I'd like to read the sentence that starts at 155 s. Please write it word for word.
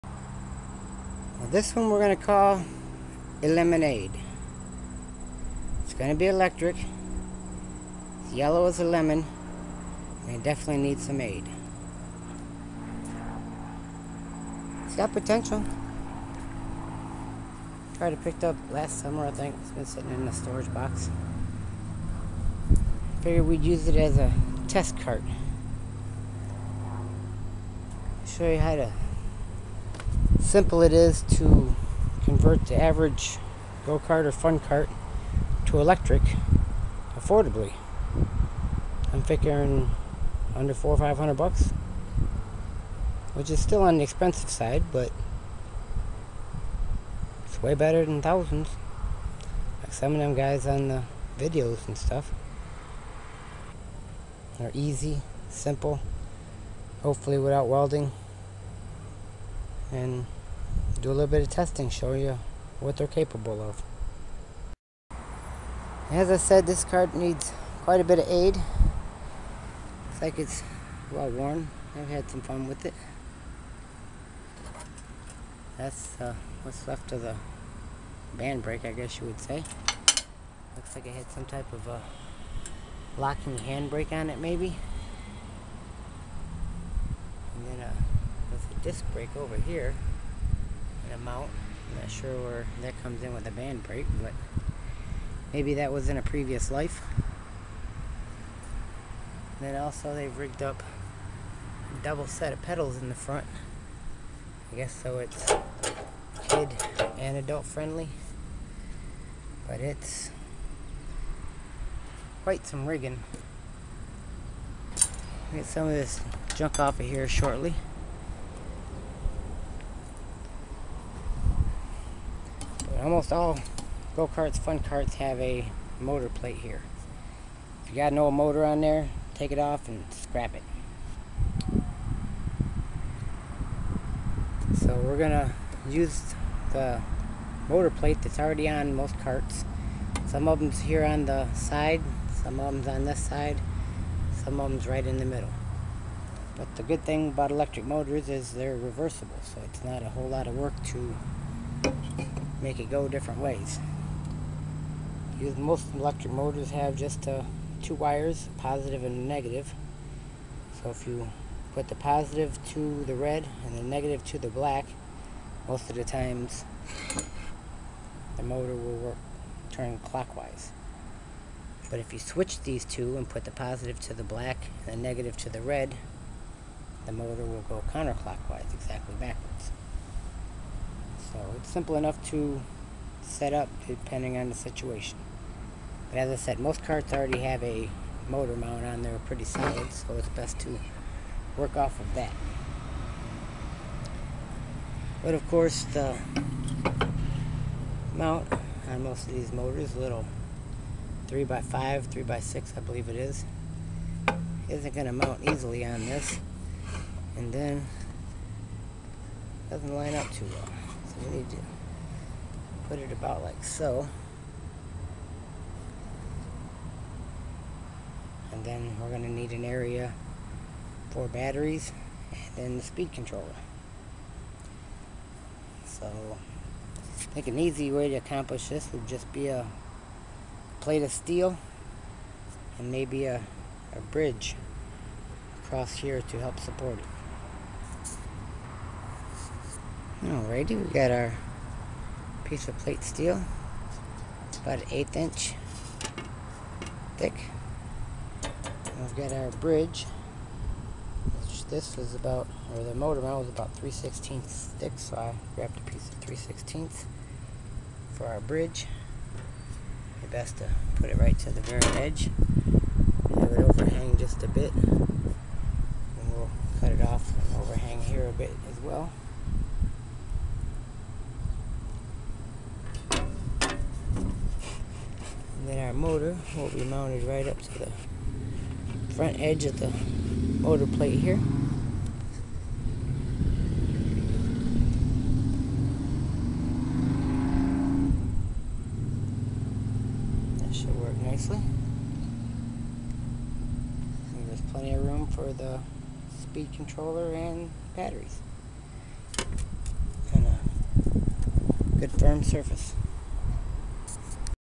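most electric motors have just uh, two wires, positive and negative.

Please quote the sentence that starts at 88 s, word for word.
disc brake over here an amount.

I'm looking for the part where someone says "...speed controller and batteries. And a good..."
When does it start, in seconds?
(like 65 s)
296 s.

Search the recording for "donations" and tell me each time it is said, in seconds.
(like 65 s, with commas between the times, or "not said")
not said.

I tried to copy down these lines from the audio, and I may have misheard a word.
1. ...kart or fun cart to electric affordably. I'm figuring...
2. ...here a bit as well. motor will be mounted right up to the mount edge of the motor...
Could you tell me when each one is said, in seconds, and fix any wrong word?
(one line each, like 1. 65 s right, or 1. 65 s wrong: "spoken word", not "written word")
1. 33 s right
2. 268 s wrong: "front", not "mount".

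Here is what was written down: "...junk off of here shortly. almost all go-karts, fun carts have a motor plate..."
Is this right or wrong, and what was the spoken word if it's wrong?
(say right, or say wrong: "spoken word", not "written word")
right.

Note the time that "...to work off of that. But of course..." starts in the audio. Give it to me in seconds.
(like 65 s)
190 s.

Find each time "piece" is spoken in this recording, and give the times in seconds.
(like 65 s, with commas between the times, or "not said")
242 s, 255 s.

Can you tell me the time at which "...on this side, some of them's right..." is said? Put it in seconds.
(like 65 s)
142 s.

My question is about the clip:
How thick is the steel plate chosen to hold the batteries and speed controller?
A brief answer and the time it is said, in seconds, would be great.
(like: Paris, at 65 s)
1/8 inch, at 244 s.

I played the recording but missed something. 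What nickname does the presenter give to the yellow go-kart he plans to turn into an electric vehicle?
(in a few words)
Lemonade.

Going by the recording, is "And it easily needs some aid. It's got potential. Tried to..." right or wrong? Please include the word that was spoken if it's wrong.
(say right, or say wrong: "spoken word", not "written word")
wrong: "definitely", not "easily".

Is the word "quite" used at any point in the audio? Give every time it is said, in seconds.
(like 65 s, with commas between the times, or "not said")
67 s, 112 s.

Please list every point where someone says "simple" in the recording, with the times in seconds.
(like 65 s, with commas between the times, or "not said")
30 s, 55 s, 181 s.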